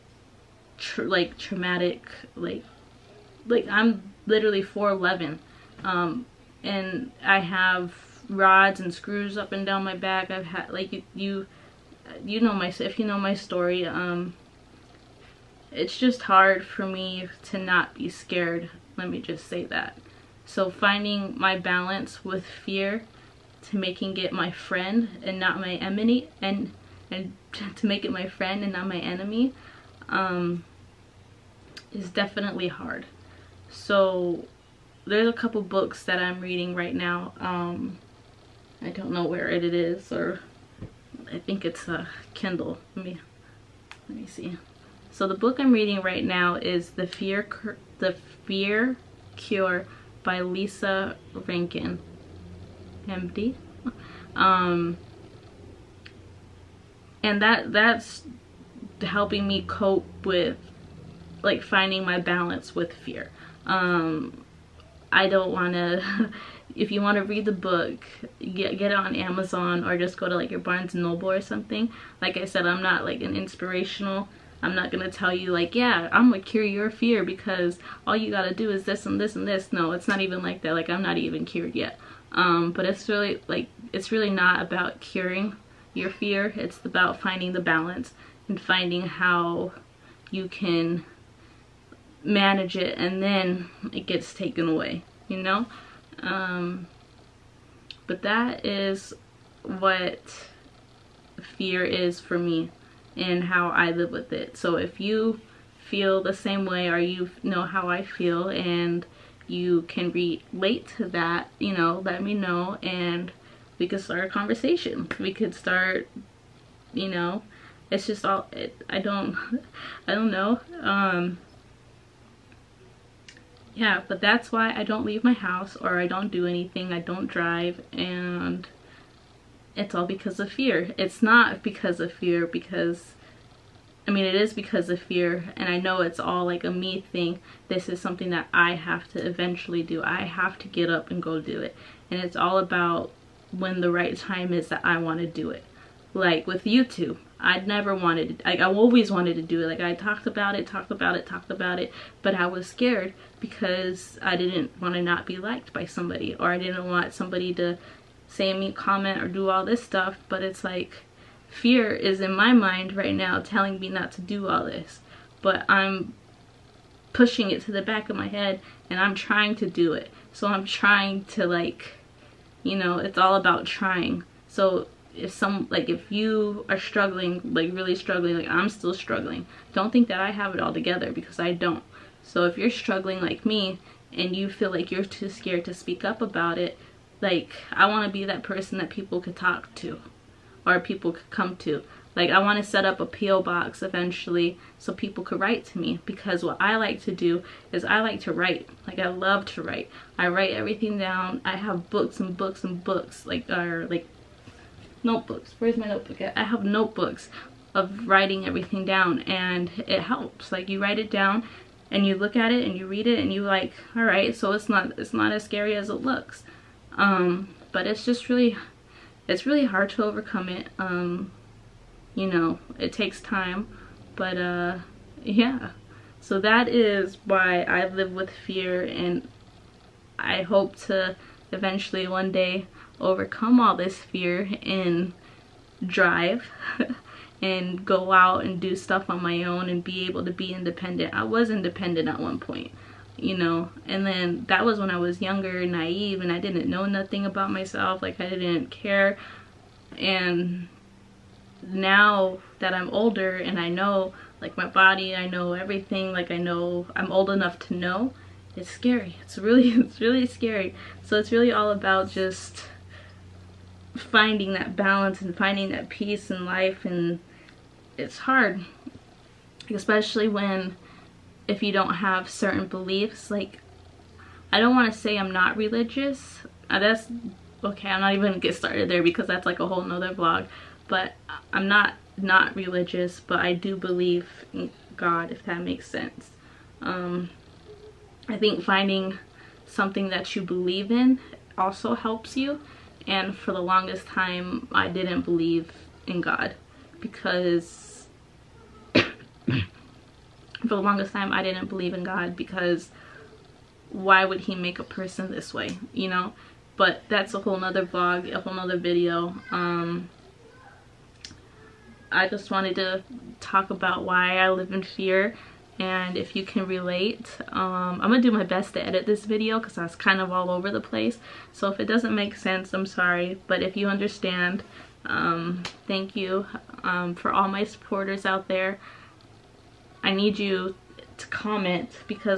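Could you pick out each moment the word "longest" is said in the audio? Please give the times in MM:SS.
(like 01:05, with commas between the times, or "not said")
04:53, 05:00.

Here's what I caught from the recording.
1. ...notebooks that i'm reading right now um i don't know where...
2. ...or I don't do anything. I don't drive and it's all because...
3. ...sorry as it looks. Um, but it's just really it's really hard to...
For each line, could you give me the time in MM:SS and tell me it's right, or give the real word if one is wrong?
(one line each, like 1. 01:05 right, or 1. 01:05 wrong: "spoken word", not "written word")
1. 00:35 wrong: "books", not "notebooks"
2. 02:05 right
3. 03:35 wrong: "scary", not "sorry".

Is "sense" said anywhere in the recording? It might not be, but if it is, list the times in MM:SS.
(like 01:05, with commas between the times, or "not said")
04:45, 05:22.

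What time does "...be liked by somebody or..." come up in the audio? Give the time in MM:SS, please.
02:35.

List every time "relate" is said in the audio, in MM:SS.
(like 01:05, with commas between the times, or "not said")
01:50, 05:16.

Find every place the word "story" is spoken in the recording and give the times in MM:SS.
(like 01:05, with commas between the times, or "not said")
00:13.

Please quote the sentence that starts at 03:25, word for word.
Where's my notebook I have notebooks of writing everything down and it helps.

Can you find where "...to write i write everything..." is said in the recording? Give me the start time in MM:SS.
03:19.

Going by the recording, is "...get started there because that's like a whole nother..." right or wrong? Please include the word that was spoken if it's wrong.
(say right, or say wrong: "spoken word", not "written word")
right.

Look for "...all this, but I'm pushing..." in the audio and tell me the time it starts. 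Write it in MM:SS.
02:44.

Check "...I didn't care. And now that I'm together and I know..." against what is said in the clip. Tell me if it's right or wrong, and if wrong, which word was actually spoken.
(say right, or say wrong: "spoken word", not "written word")
wrong: "older", not "together".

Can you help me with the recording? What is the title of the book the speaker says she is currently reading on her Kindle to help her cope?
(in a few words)
The Fear Cure.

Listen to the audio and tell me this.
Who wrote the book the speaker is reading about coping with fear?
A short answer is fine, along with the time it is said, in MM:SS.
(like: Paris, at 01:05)
Lisa Rankin, at 00:50.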